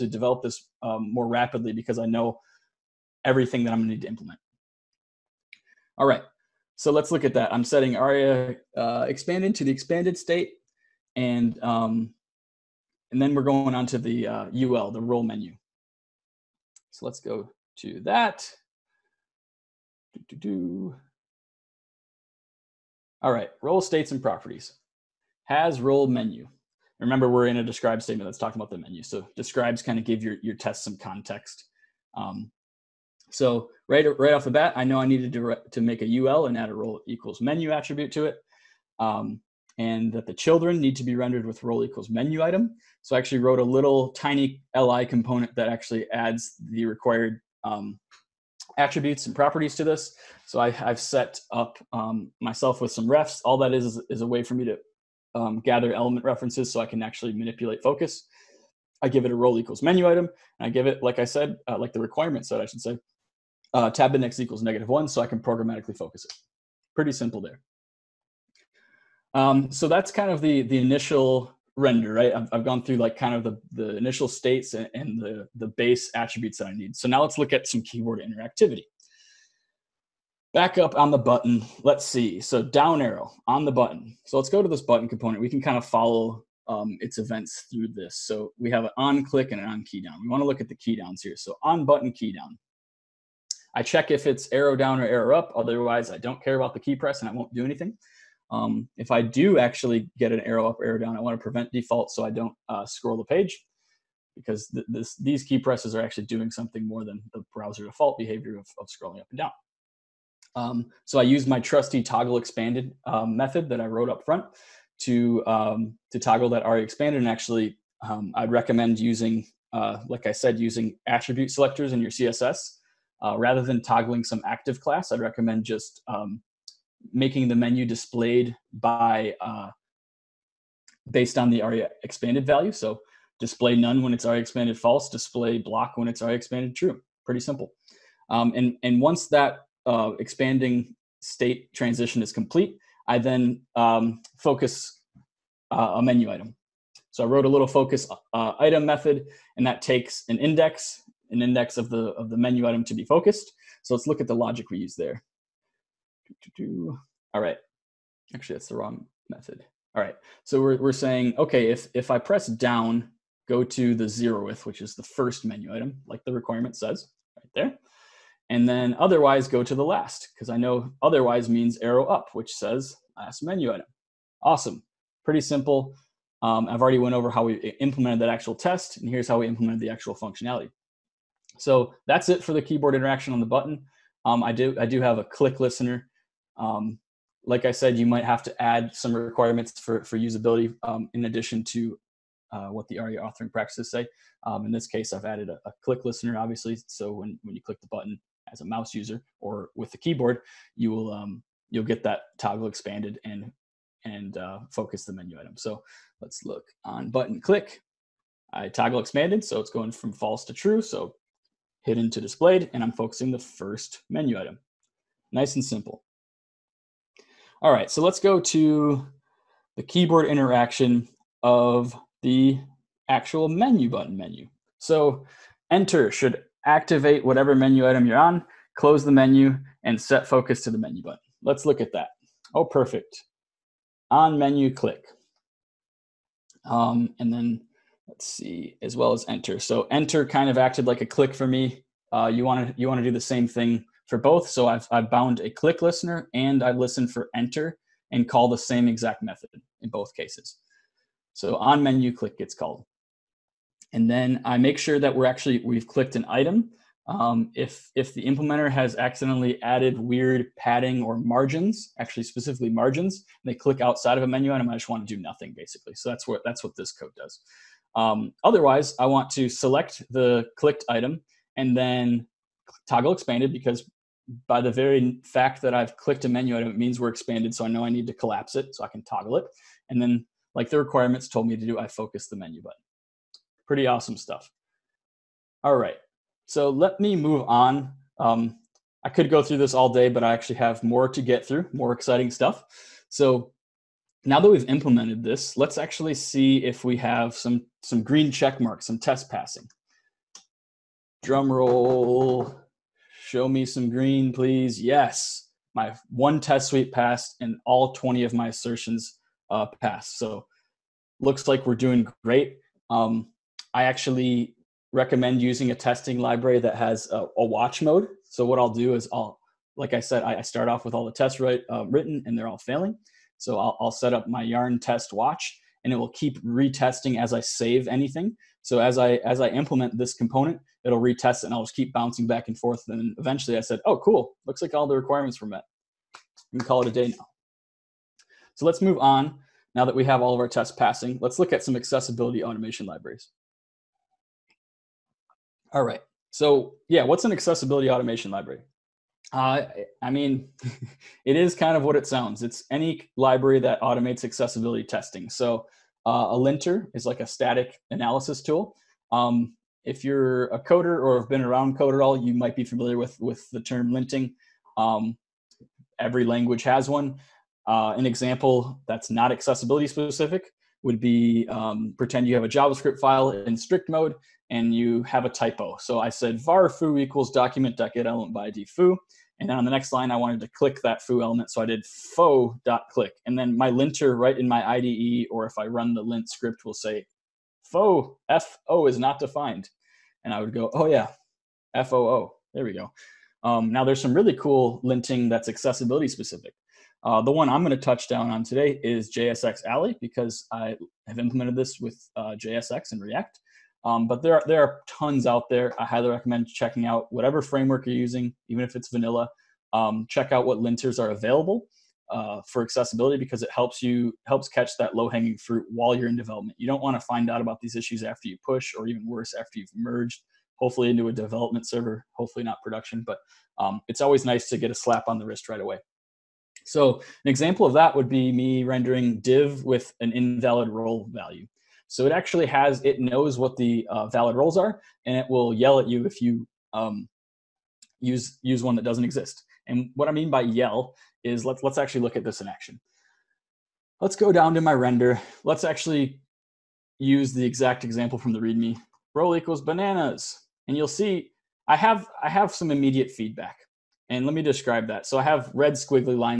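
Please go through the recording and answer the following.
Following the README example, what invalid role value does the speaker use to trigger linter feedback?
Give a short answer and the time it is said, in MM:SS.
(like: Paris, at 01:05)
bananas, at 07:29.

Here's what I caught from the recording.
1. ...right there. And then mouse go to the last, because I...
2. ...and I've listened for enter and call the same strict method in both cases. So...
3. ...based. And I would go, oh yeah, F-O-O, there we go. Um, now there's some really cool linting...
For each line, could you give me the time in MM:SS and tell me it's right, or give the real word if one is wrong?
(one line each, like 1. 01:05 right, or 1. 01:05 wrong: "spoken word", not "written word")
1. 02:47 wrong: "otherwise", not "mouse"
2. 04:06 wrong: "exact", not "strict"
3. 06:29 wrong: "defined", not "based".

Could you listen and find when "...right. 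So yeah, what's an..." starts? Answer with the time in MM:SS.
05:45.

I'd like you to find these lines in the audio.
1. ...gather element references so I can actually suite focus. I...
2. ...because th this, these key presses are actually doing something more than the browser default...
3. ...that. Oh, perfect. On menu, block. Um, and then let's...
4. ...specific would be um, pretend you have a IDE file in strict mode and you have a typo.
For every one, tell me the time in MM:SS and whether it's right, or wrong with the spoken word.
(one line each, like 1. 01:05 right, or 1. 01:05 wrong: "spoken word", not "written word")
1. 00:55 wrong: "manipulate", not "suite"
2. 01:44 right
3. 03:51 wrong: "click", not "block"
4. 06:09 wrong: "JavaScript", not "IDE".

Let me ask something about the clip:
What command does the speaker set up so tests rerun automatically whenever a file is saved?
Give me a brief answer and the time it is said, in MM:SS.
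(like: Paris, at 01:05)
yarn test watch, at 05:24.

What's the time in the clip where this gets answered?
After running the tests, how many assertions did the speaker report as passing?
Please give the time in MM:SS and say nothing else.
05:07.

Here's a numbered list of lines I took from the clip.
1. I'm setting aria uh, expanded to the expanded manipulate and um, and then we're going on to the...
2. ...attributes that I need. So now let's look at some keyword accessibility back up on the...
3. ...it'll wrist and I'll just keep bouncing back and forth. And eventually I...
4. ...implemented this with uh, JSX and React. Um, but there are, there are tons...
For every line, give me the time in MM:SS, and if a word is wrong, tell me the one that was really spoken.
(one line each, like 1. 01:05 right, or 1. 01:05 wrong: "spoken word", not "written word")
1. 00:07 wrong: "state", not "manipulate"
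2. 01:16 wrong: "interactivity", not "accessibility"
3. 05:30 wrong: "retest", not "wrist"
4. 06:41 right.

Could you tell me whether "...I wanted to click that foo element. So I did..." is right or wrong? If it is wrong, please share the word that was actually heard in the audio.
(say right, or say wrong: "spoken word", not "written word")
right.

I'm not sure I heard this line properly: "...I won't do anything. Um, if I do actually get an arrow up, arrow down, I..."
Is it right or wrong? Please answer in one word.
right.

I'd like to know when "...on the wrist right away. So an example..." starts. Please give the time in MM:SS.
07:05.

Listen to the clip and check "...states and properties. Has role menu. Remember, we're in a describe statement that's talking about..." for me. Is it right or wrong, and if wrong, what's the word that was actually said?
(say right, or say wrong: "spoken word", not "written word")
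right.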